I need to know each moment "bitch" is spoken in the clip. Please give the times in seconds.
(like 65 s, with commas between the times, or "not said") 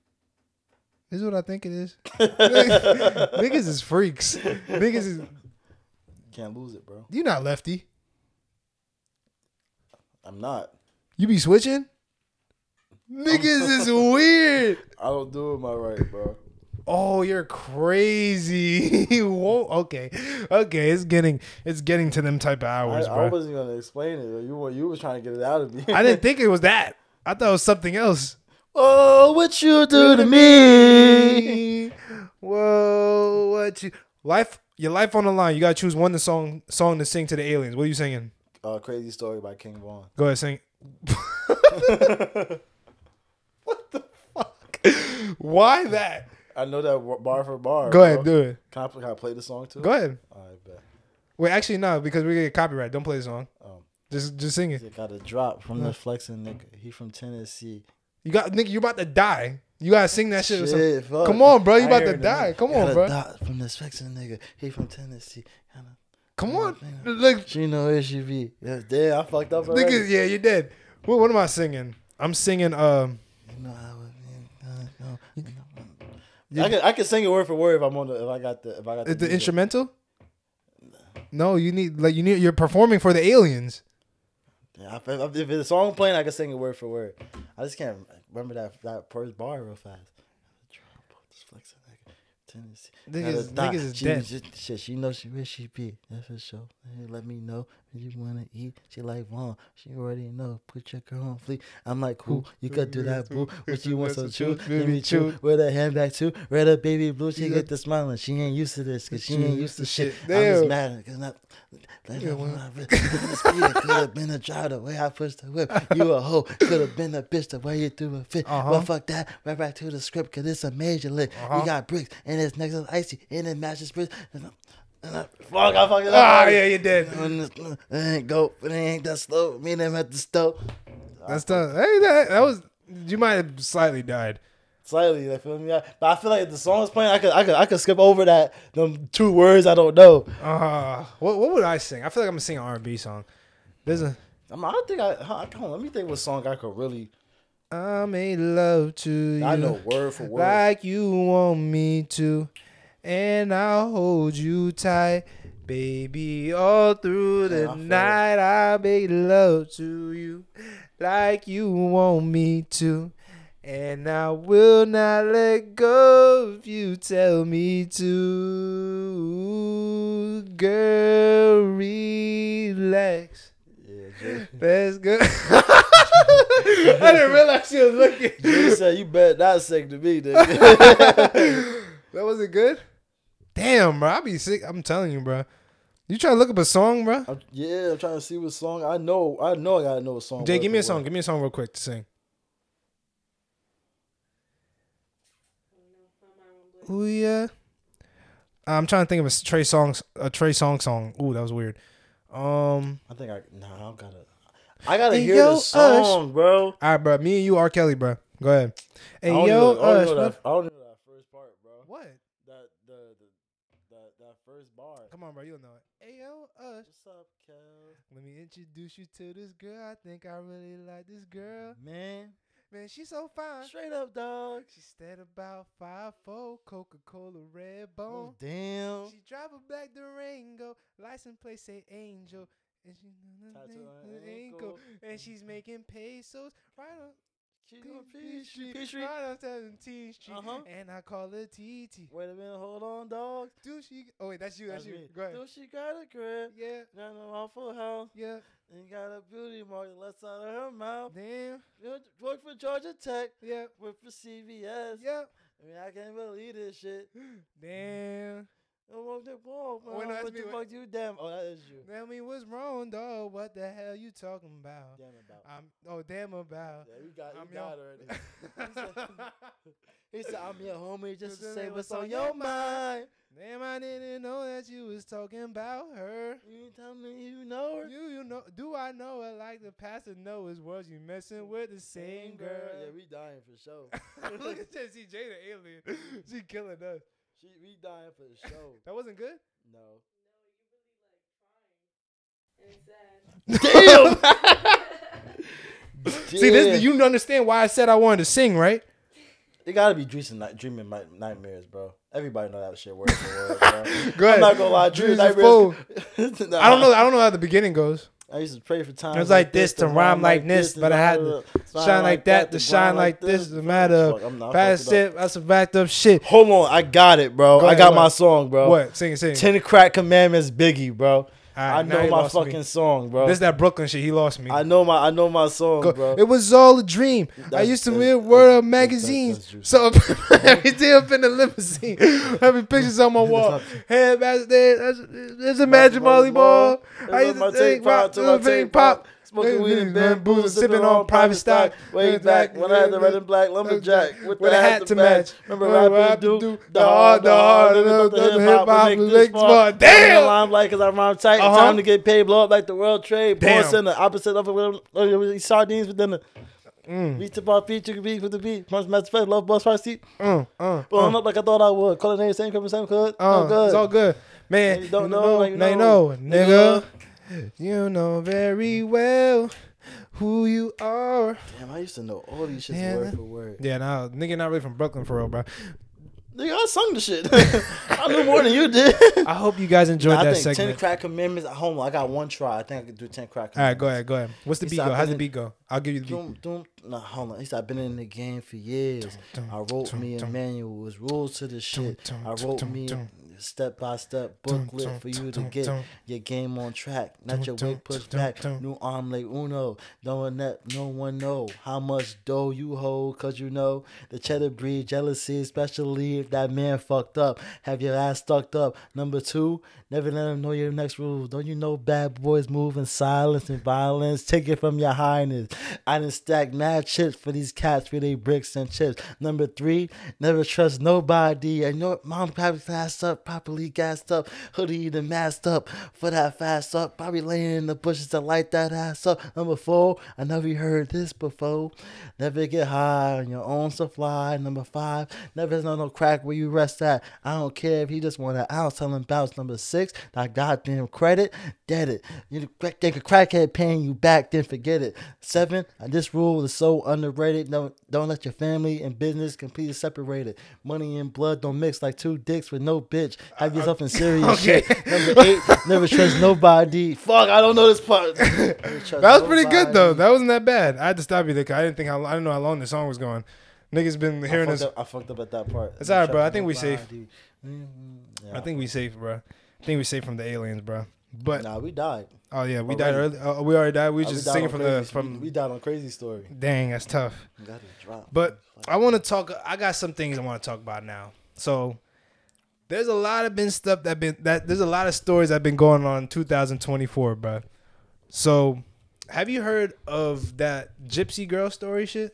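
117 s, 452 s.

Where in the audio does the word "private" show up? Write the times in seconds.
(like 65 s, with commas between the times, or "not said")
341 s.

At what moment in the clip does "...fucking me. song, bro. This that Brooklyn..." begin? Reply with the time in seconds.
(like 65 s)
322 s.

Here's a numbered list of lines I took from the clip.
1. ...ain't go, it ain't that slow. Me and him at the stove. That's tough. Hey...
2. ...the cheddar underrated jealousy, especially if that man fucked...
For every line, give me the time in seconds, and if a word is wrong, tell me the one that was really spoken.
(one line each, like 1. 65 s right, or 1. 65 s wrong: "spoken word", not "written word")
1. 127 s right
2. 404 s wrong: "breed", not "underrated".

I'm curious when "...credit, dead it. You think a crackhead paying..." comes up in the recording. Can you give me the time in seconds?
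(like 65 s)
440 s.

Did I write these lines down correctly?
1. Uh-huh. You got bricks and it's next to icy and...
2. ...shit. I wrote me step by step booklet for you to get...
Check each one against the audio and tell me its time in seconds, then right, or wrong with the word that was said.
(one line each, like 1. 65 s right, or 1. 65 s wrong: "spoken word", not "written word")
1. 121 s right
2. 391 s right.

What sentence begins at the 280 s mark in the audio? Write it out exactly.
You messing with the same girl?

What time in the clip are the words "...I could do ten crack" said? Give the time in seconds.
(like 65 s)
382 s.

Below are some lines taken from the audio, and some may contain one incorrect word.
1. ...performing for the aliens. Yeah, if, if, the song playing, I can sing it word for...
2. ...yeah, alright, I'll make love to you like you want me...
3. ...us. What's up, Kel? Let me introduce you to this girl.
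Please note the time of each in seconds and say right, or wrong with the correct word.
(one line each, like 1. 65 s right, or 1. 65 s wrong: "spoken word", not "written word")
1. 82 s right
2. 157 s wrong: "night", not "alright"
3. 216 s right.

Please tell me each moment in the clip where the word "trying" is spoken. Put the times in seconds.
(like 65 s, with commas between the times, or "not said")
25 s, 187 s, 198 s, 293 s.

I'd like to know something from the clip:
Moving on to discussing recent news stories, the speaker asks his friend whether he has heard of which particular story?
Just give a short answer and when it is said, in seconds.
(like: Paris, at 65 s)
Gypsy Girl story, at 490 s.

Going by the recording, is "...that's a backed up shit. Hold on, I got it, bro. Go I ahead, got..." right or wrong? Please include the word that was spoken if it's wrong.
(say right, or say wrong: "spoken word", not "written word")
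right.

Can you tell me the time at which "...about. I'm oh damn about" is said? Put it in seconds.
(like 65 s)
265 s.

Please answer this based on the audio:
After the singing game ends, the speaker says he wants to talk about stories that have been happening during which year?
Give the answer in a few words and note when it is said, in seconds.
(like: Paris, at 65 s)
2024, at 486 s.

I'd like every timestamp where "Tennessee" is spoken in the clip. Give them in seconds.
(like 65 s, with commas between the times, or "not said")
57 s, 64 s, 92 s.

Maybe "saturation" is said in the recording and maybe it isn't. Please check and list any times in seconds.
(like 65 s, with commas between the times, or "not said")
not said.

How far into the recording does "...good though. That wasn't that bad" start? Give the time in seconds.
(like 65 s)
459 s.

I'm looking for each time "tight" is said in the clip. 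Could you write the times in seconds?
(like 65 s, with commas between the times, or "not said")
154 s, 351 s.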